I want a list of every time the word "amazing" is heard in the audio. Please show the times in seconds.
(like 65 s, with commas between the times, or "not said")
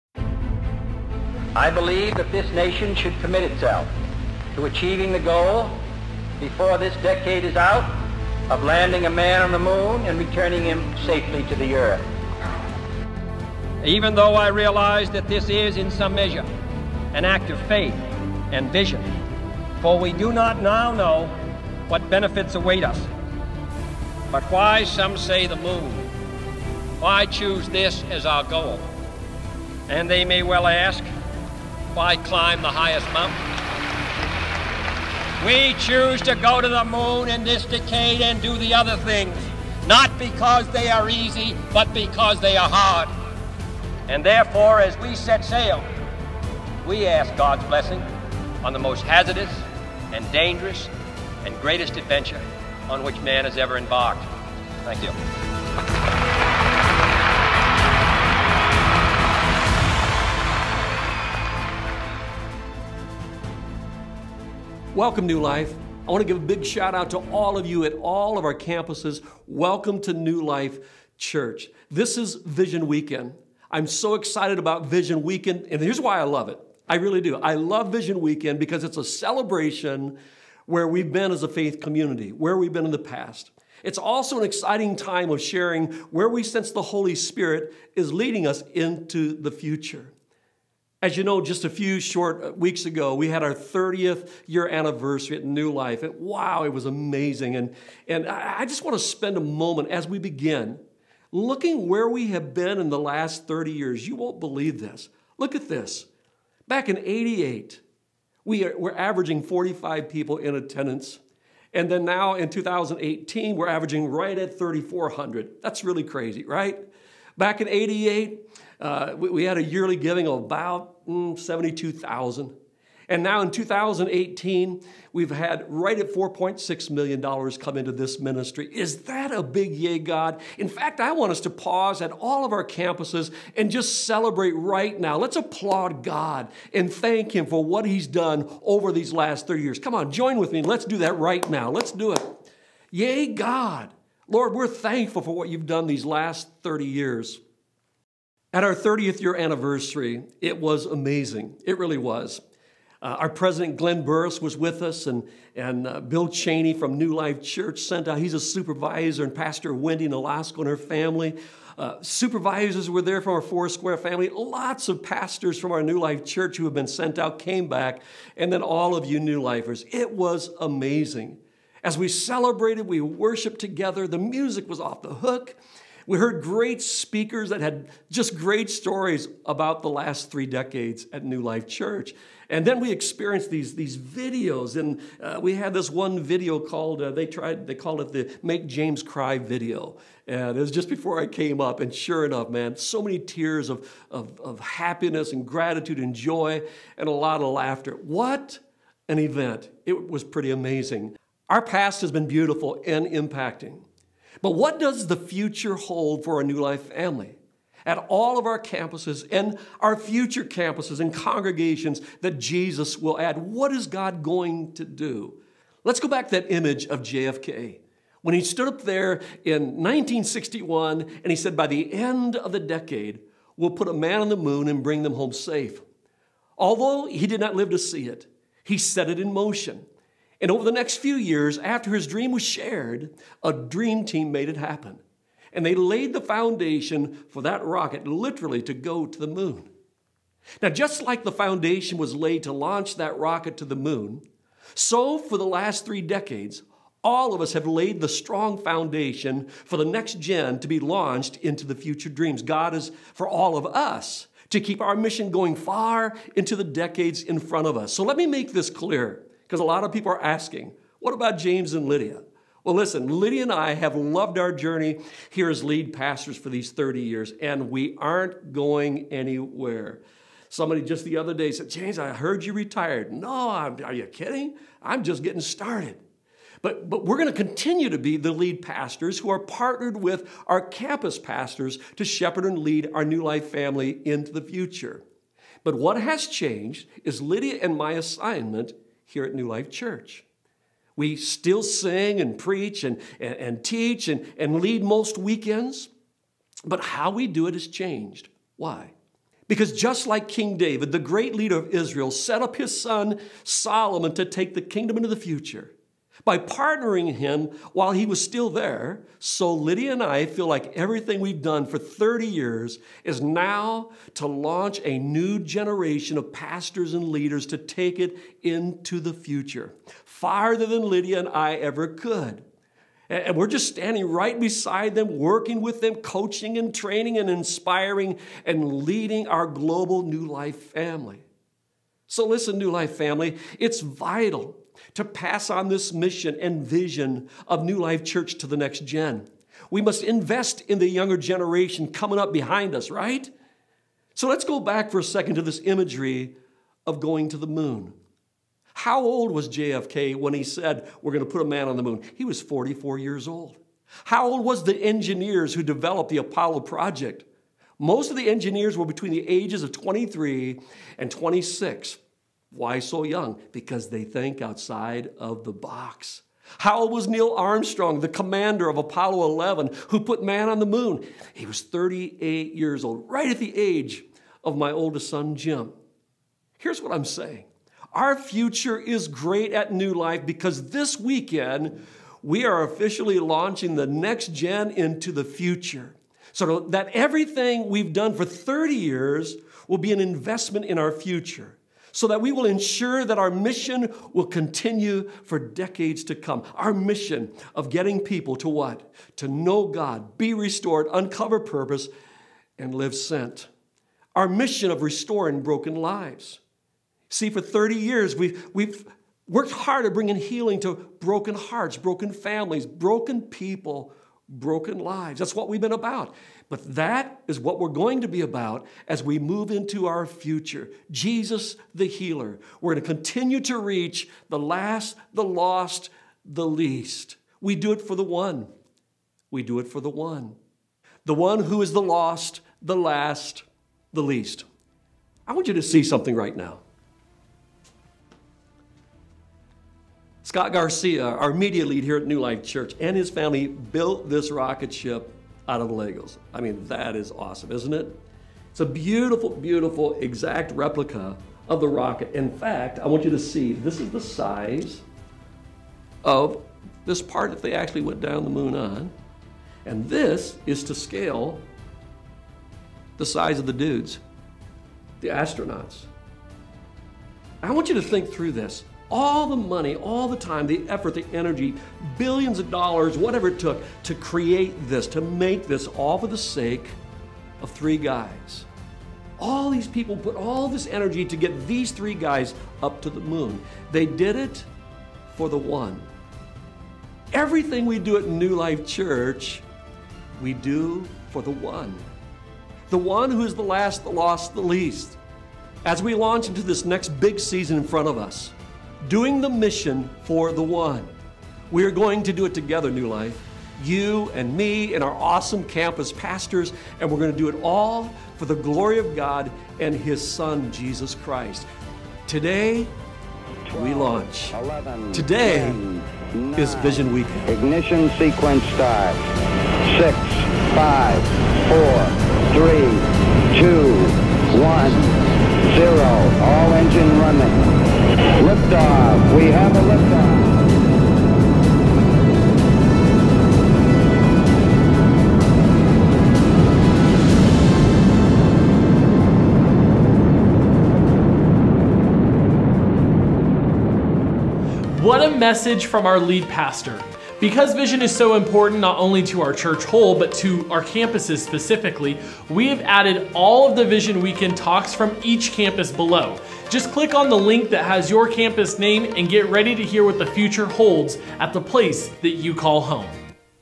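96 s, 150 s, 170 s, 200 s.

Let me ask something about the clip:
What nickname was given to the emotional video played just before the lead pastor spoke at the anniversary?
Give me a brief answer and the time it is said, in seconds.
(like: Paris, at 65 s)
Make James Cry, at 188 s.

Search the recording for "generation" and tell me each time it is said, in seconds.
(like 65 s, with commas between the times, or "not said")
315 s, 341 s.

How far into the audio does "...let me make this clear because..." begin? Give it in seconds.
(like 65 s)
258 s.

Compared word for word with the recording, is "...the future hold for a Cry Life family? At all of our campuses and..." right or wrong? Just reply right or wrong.
wrong.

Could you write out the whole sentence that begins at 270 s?
Somebody just the other day said, James, I heard you retired.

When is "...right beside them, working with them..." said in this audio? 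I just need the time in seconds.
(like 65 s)
324 s.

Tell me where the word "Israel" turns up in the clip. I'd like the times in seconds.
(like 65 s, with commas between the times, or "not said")
301 s.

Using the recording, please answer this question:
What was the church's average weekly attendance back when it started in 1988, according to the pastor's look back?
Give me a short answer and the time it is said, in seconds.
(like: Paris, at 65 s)
45, at 109 s.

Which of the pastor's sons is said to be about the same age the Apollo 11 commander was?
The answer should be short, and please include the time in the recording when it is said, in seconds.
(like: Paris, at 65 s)
Jim, at 375 s.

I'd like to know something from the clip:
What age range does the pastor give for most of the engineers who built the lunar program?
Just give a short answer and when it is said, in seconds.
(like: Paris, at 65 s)
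23 to 26, at 358 s.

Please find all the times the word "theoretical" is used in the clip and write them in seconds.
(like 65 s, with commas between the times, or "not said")
not said.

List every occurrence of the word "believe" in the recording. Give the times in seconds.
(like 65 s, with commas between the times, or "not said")
1 s, 104 s.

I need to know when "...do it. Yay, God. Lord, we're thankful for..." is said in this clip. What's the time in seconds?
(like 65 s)
141 s.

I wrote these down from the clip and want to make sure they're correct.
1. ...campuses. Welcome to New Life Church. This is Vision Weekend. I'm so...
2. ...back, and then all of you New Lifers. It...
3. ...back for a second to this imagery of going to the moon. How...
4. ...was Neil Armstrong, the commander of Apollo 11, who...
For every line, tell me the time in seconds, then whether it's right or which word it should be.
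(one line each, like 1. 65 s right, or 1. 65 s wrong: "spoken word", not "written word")
1. 68 s right
2. 167 s right
3. 344 s right
4. 366 s right.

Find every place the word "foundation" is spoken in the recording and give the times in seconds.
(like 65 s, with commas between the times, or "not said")
236 s, 241 s, 248 s.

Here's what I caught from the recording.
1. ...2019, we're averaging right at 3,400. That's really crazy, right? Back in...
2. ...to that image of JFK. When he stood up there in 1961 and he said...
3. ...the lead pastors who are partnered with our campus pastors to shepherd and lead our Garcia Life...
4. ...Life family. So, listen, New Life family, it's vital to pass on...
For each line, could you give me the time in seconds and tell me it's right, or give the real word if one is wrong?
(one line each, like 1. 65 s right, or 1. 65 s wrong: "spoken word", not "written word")
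1. 112 s wrong: "2018", not "2019"
2. 216 s right
3. 278 s wrong: "New", not "Garcia"
4. 330 s right.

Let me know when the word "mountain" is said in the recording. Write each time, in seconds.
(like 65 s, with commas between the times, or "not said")
33 s.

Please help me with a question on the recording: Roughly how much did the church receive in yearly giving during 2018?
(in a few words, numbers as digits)
$4.6 million.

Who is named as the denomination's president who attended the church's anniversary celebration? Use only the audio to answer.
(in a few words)
Glenn Burris.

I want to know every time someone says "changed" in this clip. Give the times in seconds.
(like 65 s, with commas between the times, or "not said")
286 s, 297 s.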